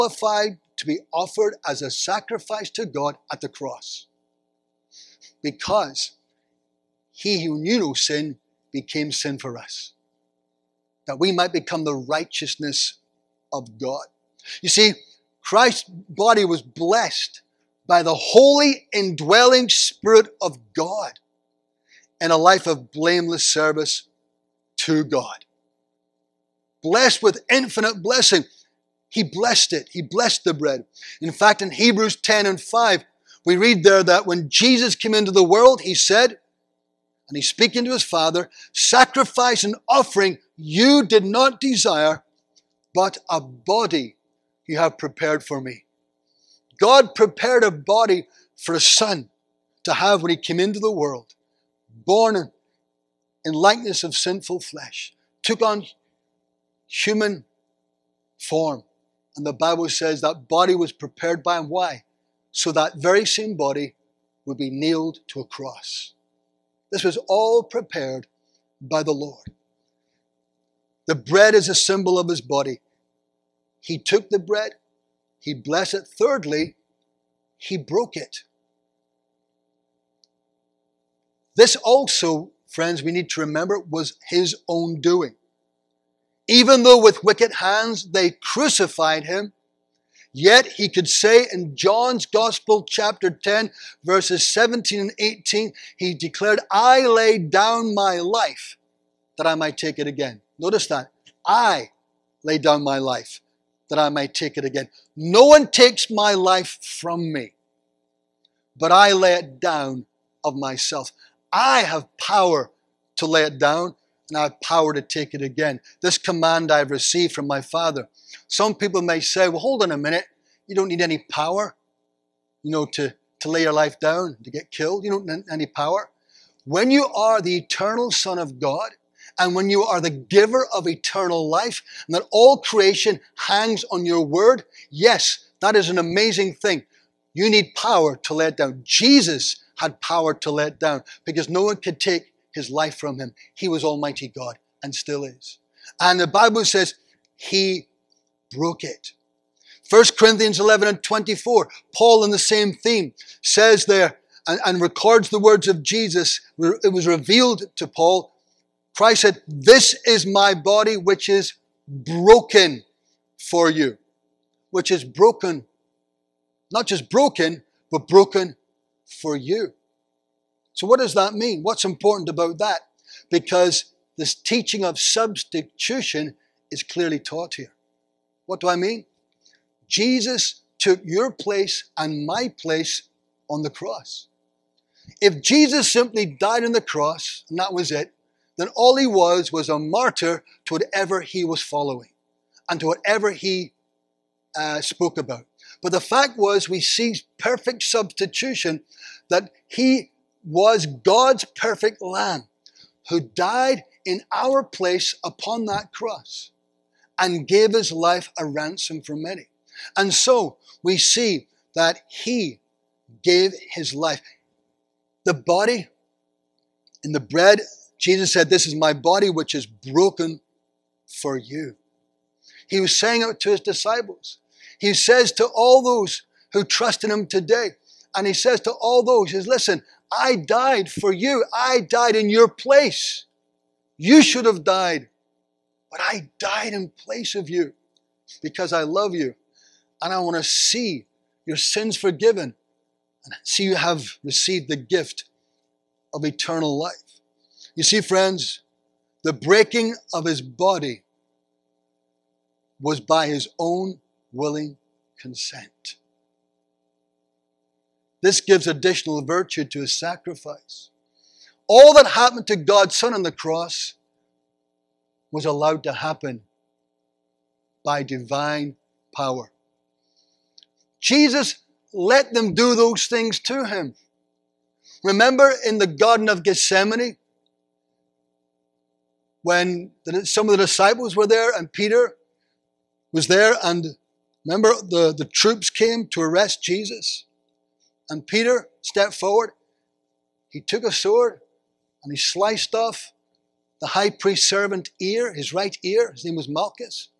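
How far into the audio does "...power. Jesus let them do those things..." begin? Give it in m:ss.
4:29.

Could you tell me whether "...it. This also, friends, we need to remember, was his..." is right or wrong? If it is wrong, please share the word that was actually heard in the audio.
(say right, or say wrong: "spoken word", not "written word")
right.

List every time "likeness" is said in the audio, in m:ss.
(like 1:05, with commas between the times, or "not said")
0:53.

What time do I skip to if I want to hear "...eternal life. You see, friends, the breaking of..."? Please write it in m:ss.
4:06.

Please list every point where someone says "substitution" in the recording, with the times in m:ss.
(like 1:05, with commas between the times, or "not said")
2:54, 3:17.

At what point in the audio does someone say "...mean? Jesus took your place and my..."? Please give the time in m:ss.
2:58.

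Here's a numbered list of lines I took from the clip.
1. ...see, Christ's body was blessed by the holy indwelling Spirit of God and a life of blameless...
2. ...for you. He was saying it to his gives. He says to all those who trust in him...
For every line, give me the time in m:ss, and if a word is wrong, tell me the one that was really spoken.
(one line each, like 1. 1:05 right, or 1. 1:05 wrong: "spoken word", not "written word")
1. 0:14 right
2. 3:41 wrong: "disciples", not "gives".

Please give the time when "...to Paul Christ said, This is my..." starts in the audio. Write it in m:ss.
2:37.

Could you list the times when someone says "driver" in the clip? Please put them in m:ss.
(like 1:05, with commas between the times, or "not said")
not said.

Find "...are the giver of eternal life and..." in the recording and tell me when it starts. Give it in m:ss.
2:09.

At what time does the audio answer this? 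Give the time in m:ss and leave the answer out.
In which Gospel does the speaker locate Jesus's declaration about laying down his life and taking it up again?
1:31.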